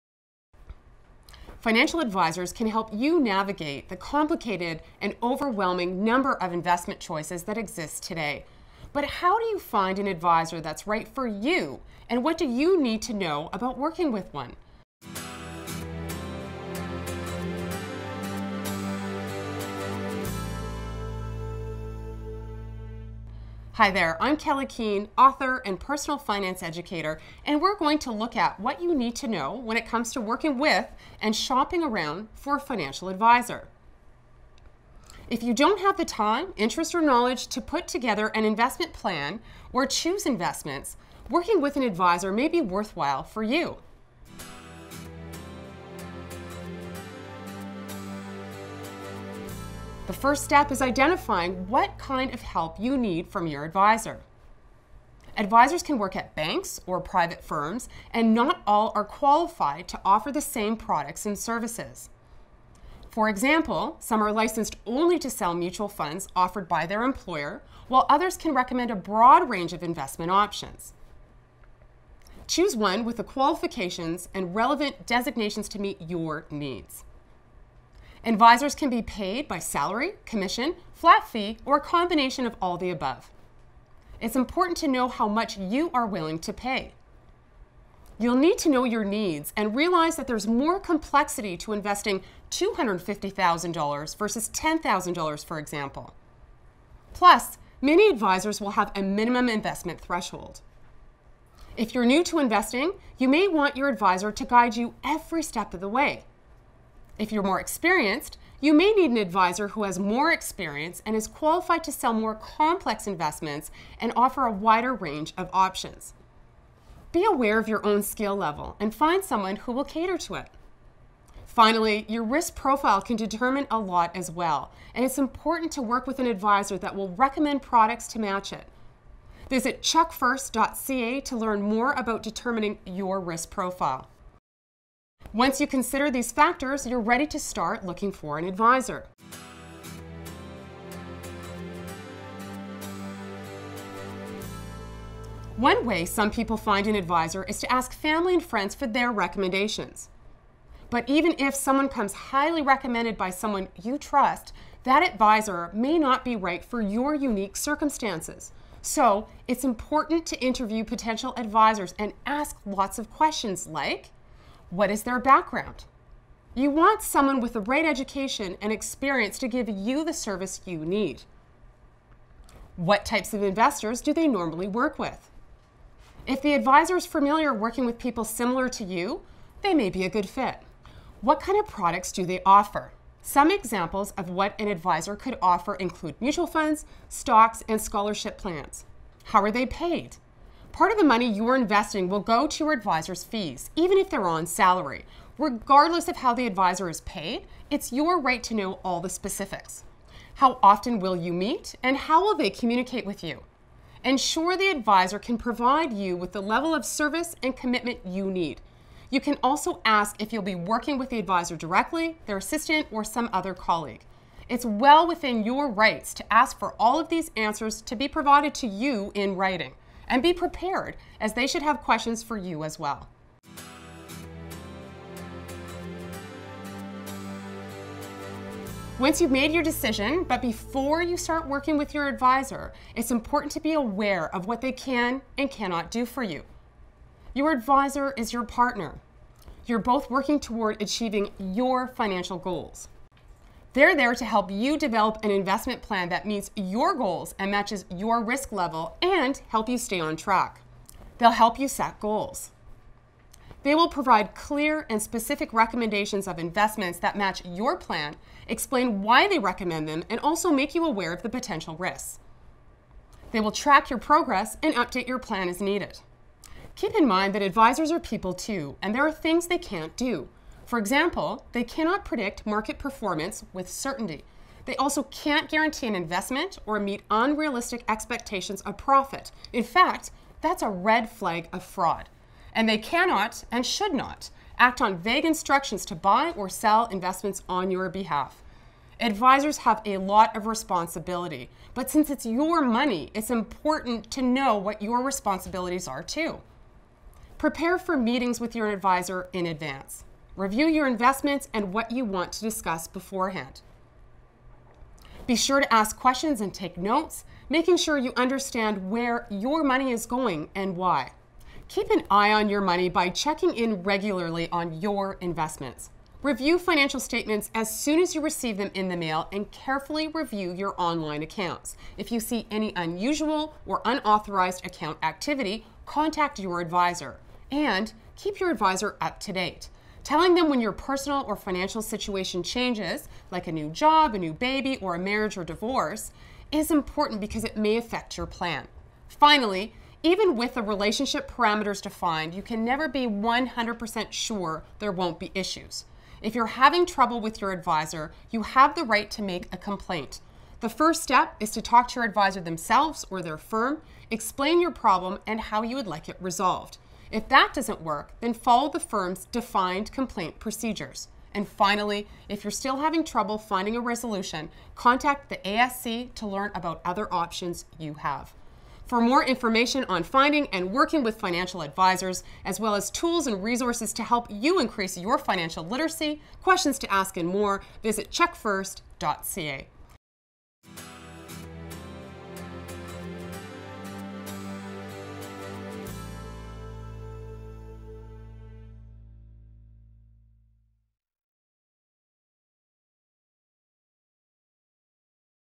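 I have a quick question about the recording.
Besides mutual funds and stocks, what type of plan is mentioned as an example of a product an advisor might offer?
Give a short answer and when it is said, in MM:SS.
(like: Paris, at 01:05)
Scholarship plans, at 03:07.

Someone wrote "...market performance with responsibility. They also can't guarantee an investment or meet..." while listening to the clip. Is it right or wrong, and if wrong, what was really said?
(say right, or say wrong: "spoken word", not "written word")
wrong: "certainty", not "responsibility".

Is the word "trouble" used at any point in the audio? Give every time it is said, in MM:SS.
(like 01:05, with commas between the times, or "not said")
05:46, 06:03.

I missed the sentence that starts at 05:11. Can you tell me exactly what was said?
Keep an eye on your money by checking in regularly on your investments.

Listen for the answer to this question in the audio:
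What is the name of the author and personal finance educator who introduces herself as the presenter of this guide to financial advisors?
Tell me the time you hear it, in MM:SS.
00:24.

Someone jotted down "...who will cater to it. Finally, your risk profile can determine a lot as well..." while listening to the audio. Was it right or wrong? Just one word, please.
right.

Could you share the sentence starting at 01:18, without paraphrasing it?
Advisors can be paid by salary, commission, flat fee, or a combination of all the above.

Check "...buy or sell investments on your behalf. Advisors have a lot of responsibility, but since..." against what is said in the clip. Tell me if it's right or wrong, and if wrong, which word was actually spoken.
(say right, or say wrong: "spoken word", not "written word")
right.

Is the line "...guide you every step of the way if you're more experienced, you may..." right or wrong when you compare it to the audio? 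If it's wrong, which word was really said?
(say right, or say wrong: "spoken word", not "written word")
right.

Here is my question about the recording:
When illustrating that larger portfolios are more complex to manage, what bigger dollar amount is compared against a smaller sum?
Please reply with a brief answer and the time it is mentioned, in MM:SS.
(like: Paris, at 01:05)
$250,000, at 01:32.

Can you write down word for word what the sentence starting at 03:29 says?
You can also ask if you'll be working with the advisor directly, their assistant, or some other colleague.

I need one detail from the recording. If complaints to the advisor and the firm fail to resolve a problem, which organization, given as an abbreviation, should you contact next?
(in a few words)
ASC.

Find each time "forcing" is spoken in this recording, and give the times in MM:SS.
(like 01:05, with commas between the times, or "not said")
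not said.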